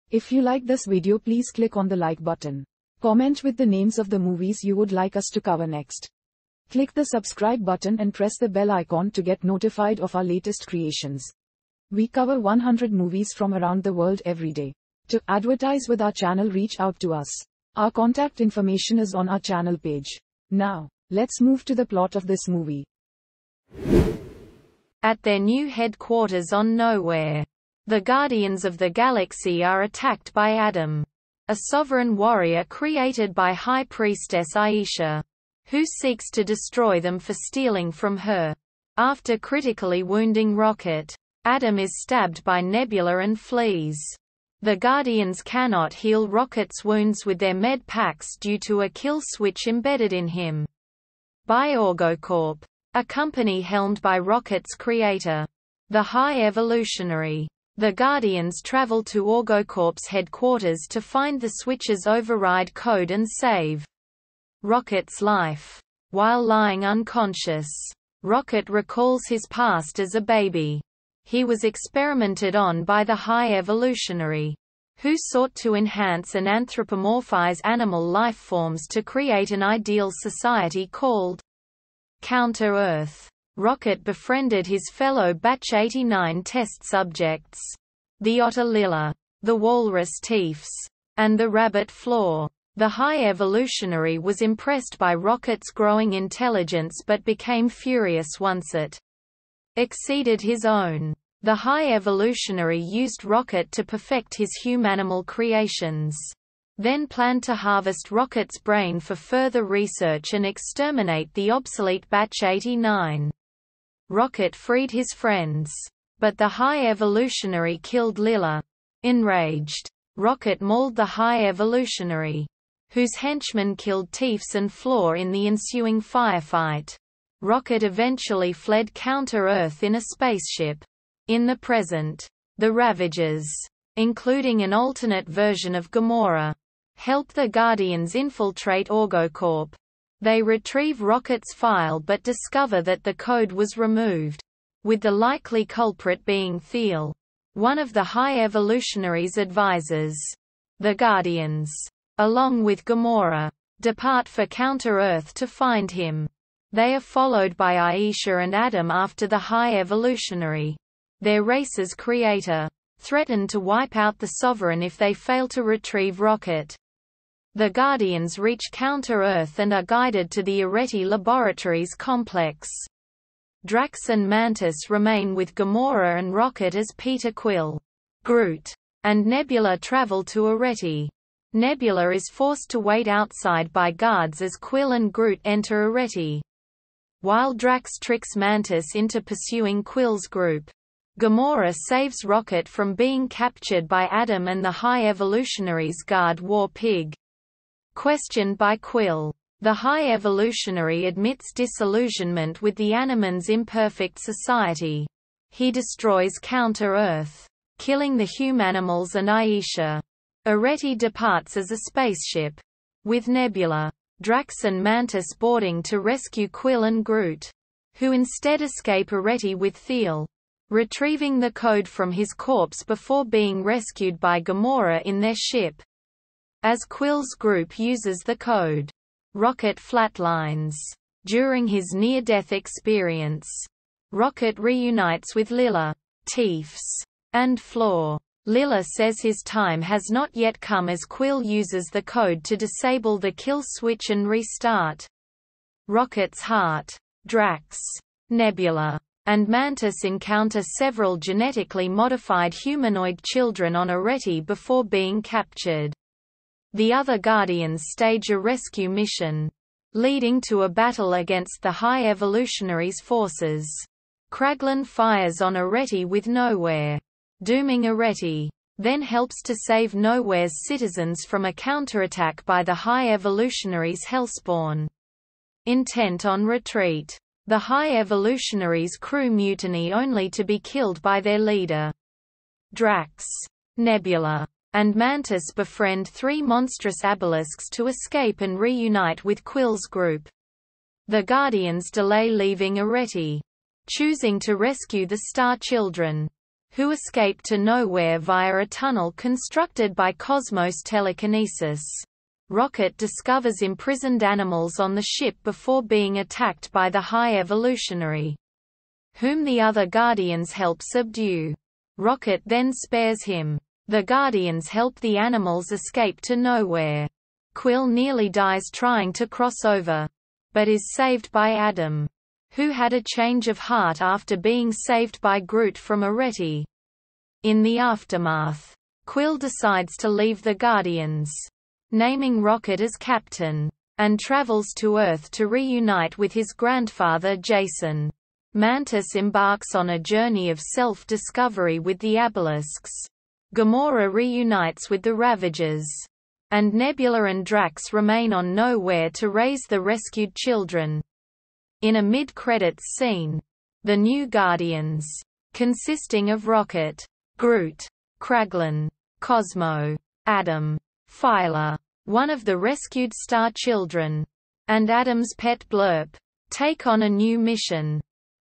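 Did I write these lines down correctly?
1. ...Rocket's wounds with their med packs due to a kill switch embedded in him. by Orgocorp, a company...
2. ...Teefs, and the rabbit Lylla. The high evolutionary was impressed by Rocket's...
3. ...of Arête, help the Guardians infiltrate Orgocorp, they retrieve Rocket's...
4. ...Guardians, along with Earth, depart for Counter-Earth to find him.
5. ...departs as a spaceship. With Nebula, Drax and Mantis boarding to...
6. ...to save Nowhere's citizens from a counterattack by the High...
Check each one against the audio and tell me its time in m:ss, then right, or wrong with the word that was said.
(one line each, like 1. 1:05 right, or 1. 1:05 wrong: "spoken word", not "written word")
1. 0:46 right
2. 1:30 wrong: "Floor", not "Lylla"
3. 2:15 wrong: "Gamora", not "Arête"
4. 2:30 wrong: "Gamora", not "Earth"
5. 3:30 right
6. 4:29 right.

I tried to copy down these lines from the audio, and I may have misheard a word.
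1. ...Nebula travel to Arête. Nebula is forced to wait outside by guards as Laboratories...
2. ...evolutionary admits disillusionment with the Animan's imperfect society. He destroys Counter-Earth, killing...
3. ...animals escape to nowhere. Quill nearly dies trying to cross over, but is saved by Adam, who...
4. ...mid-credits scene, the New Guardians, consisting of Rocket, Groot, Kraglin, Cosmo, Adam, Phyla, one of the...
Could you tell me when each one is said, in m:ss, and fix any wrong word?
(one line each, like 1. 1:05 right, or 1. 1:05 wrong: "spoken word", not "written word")
1. 2:59 wrong: "Quill", not "Laboratories"
2. 3:20 right
3. 5:15 right
4. 5:52 right.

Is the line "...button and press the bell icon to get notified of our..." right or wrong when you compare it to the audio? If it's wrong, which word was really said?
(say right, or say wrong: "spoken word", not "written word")
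right.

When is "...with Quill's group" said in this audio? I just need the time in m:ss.
4:49.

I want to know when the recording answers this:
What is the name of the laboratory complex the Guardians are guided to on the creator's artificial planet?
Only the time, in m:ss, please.
2:50.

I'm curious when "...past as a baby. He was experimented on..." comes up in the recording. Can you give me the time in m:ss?
1:09.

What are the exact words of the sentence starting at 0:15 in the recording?
To advertise with our channel reach out to us.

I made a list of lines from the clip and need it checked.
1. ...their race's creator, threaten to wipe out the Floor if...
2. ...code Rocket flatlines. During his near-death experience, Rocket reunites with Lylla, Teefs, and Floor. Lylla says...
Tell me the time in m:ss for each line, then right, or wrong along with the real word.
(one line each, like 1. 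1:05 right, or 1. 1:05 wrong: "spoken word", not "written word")
1. 2:41 wrong: "Sovereign", not "Floor"
2. 3:48 right.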